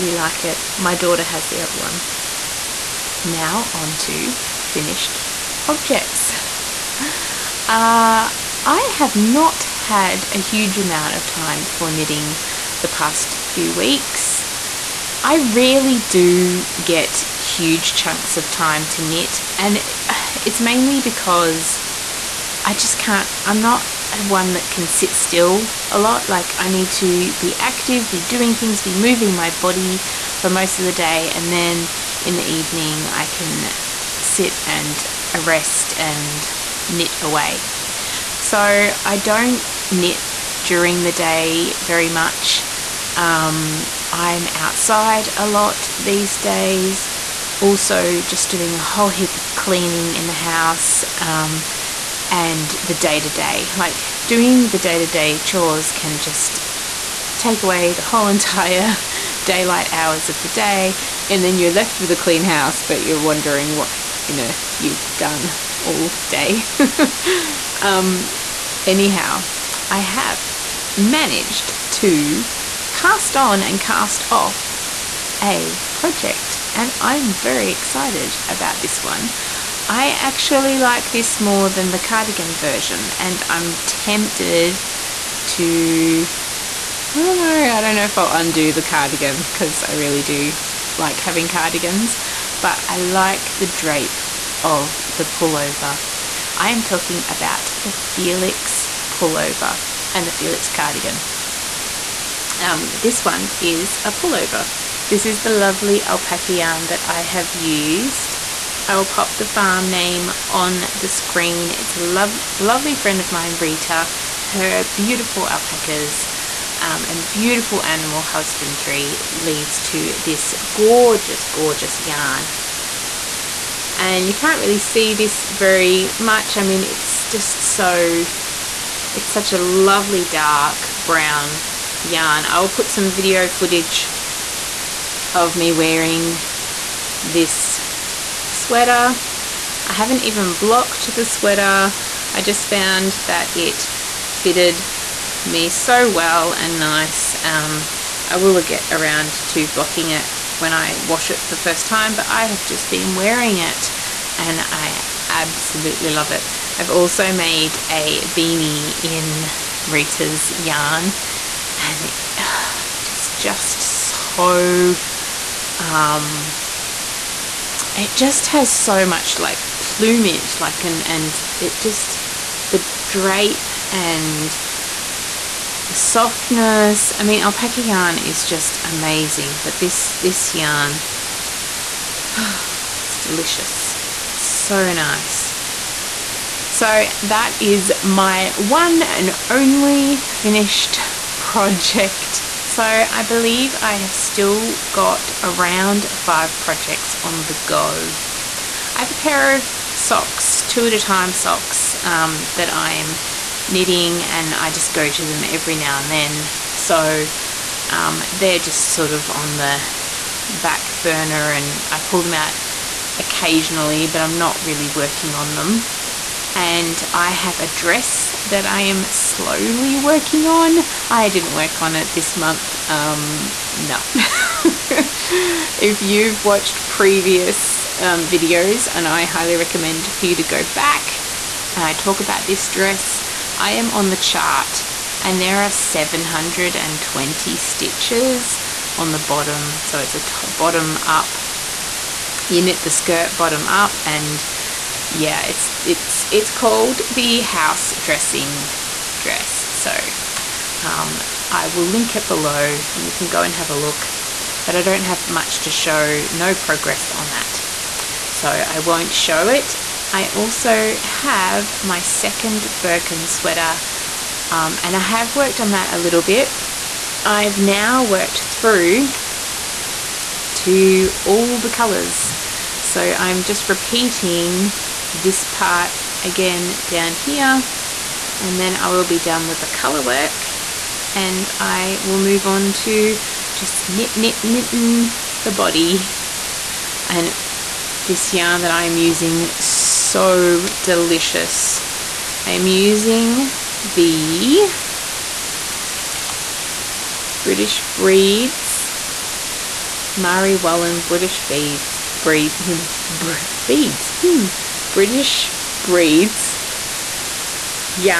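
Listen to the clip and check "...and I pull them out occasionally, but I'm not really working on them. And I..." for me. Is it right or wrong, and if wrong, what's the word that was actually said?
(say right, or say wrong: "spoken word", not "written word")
right.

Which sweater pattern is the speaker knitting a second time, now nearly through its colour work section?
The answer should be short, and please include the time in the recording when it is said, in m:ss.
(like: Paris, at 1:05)
Birkin, at 4:22.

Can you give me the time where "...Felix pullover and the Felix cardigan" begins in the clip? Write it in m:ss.
1:37.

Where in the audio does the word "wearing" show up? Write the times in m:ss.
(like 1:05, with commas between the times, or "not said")
2:15, 2:33.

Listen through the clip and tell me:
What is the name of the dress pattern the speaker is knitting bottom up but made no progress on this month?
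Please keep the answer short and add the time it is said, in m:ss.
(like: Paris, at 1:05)
House Dressing dress, at 4:07.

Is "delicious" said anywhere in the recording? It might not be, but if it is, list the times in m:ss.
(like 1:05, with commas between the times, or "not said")
3:03, 4:50.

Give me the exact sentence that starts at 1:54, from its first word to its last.
Her beautiful alpacas um, and beautiful animal husbandry leads to this gorgeous, gorgeous yarn.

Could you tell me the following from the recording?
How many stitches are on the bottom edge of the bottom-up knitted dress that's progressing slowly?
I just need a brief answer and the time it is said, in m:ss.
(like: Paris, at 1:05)
720, at 3:55.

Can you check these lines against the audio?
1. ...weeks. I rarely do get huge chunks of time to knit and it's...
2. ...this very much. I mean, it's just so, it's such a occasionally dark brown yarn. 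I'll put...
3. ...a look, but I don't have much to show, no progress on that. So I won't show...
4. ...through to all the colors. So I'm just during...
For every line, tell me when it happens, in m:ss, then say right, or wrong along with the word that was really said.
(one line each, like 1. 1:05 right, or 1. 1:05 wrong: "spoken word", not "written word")
1. 0:13 right
2. 2:05 wrong: "lovely", not "occasionally"
3. 4:13 right
4. 4:28 wrong: "repeating", not "during".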